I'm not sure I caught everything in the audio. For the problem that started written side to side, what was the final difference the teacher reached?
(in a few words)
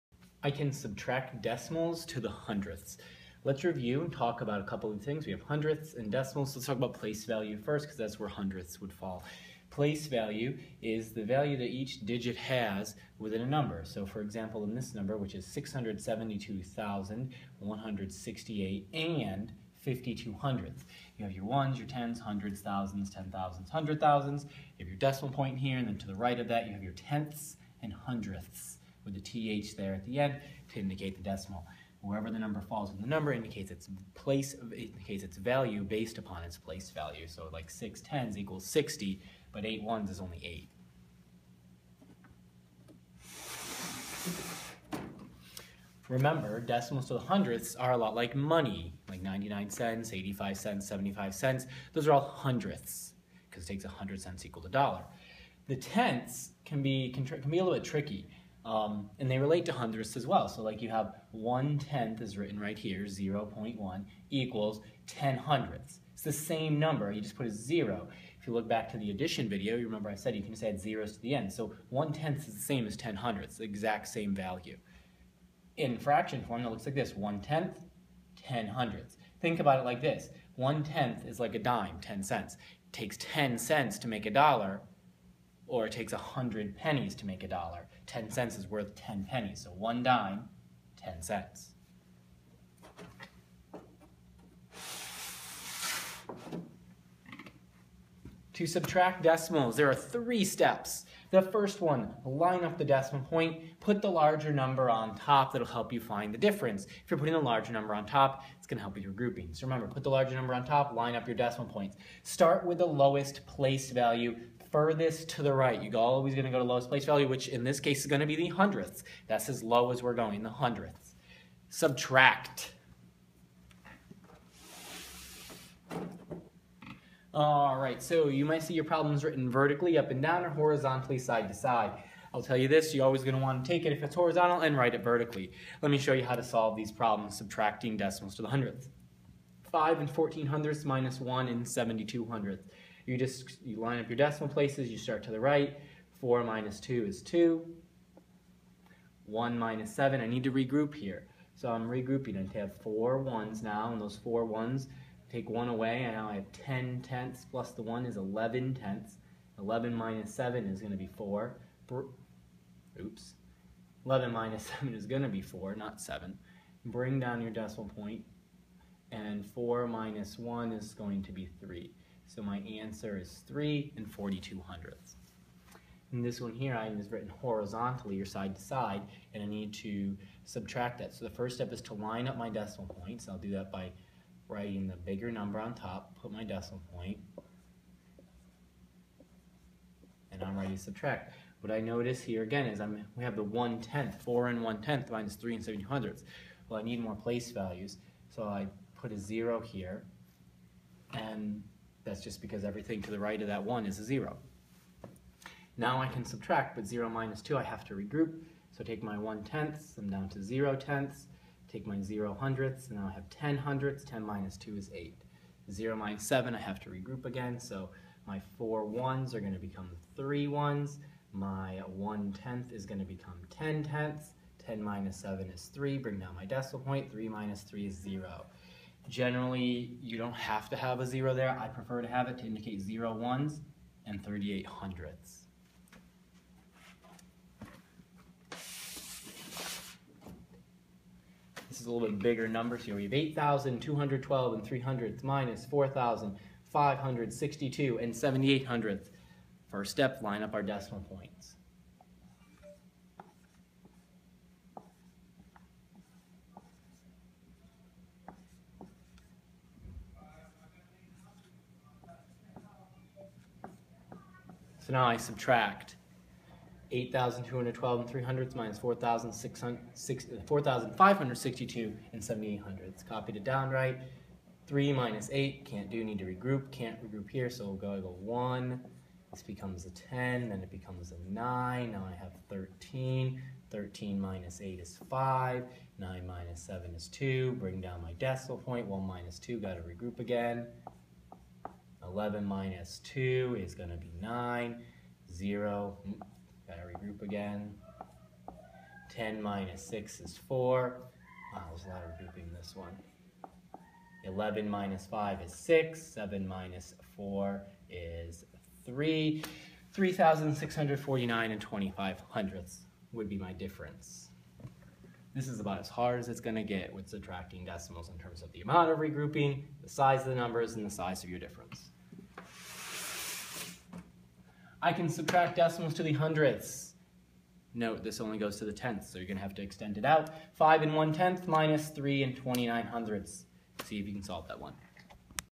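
0.38.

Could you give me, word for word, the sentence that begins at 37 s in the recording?
So like six tens equals 60, but eight ones is only eight.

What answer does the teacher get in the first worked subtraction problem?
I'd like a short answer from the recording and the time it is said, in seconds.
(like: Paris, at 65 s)
3.42, at 173 s.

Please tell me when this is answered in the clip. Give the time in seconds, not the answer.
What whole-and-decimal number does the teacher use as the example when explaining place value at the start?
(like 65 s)
15 s.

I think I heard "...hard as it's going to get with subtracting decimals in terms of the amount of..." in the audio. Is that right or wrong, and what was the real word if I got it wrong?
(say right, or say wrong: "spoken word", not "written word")
right.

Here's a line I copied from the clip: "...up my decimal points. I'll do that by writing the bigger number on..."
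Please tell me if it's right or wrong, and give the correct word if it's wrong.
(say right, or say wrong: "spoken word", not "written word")
right.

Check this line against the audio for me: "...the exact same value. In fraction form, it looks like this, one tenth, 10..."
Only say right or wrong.
right.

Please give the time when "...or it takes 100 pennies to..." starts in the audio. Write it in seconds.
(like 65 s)
85 s.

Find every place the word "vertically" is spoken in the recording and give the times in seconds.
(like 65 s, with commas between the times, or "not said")
129 s, 135 s.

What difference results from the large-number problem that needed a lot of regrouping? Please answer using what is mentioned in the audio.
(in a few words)
3,649.25.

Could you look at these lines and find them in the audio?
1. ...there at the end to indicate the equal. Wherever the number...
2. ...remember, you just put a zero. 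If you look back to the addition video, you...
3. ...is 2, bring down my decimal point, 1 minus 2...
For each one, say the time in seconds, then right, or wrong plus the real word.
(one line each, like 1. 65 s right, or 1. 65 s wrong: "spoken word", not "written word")
1. 29 s wrong: "decimal", not "equal"
2. 66 s wrong: "number", not "remember"
3. 286 s right.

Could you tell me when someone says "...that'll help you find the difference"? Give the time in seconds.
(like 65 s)
105 s.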